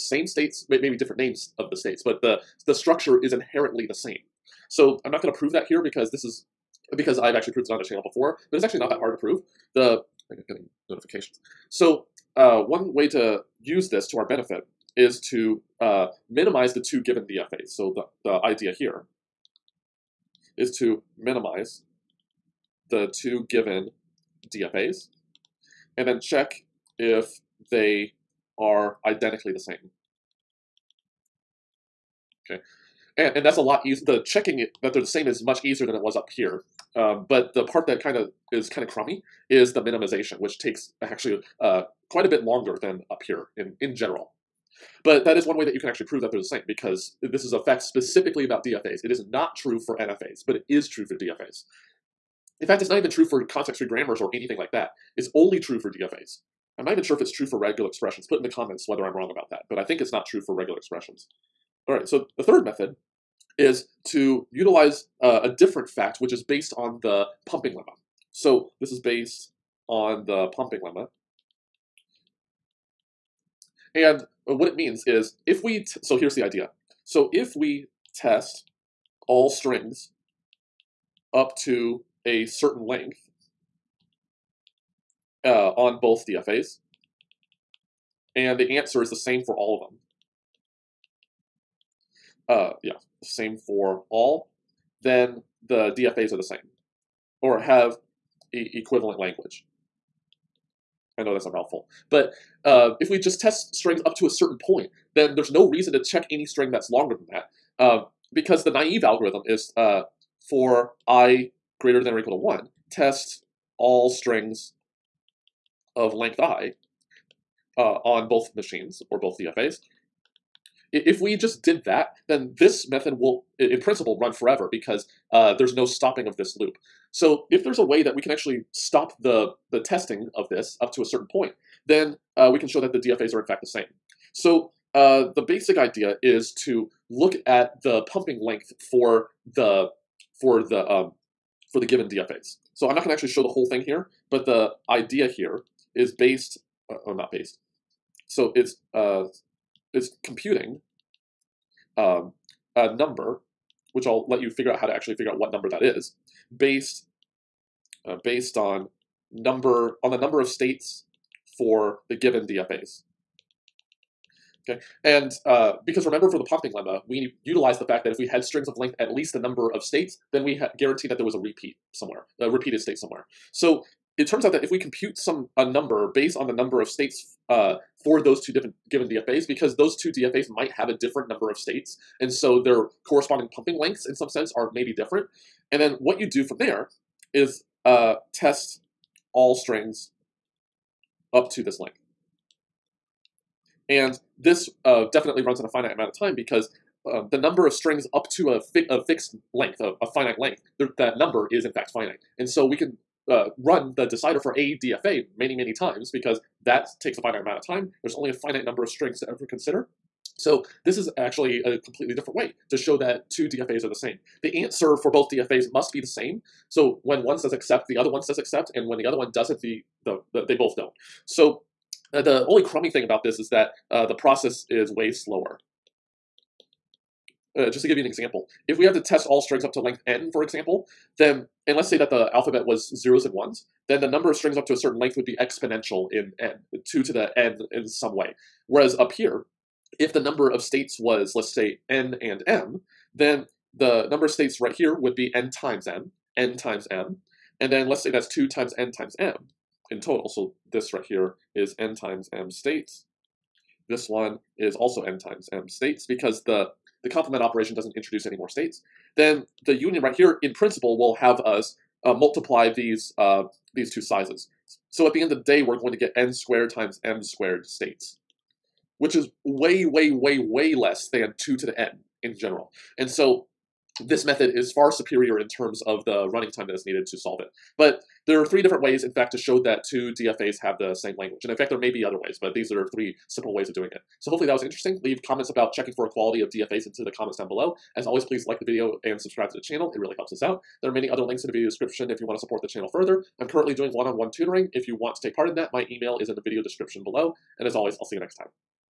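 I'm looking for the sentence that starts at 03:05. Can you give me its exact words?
And then what you do from there is uh, test all strings up to this length.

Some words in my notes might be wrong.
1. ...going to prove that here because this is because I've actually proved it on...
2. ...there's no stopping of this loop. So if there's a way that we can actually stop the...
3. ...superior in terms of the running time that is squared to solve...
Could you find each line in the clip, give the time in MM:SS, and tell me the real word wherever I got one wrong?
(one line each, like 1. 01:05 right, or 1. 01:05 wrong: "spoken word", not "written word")
1. 00:05 right
2. 02:05 right
3. 04:34 wrong: "needed", not "squared".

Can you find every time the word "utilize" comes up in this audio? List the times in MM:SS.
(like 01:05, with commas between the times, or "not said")
01:04, 02:47.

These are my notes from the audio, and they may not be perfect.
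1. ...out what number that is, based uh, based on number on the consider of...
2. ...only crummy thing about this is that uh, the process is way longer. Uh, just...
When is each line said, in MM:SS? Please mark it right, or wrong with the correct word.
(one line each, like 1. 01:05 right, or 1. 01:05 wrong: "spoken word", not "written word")
1. 02:35 wrong: "number", not "consider"
2. 03:42 wrong: "slower", not "longer".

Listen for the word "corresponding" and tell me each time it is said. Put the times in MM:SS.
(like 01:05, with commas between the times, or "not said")
03:03.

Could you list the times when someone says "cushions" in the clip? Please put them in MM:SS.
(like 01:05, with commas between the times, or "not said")
not said.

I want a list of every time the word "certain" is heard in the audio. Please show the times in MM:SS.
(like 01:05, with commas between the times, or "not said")
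01:22, 01:44, 02:11, 03:54.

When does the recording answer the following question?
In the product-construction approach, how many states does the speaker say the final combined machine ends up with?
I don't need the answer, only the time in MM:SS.
04:26.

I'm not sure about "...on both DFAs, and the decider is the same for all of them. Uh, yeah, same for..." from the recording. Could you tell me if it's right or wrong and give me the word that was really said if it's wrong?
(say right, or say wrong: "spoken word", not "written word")
wrong: "answer", not "decider".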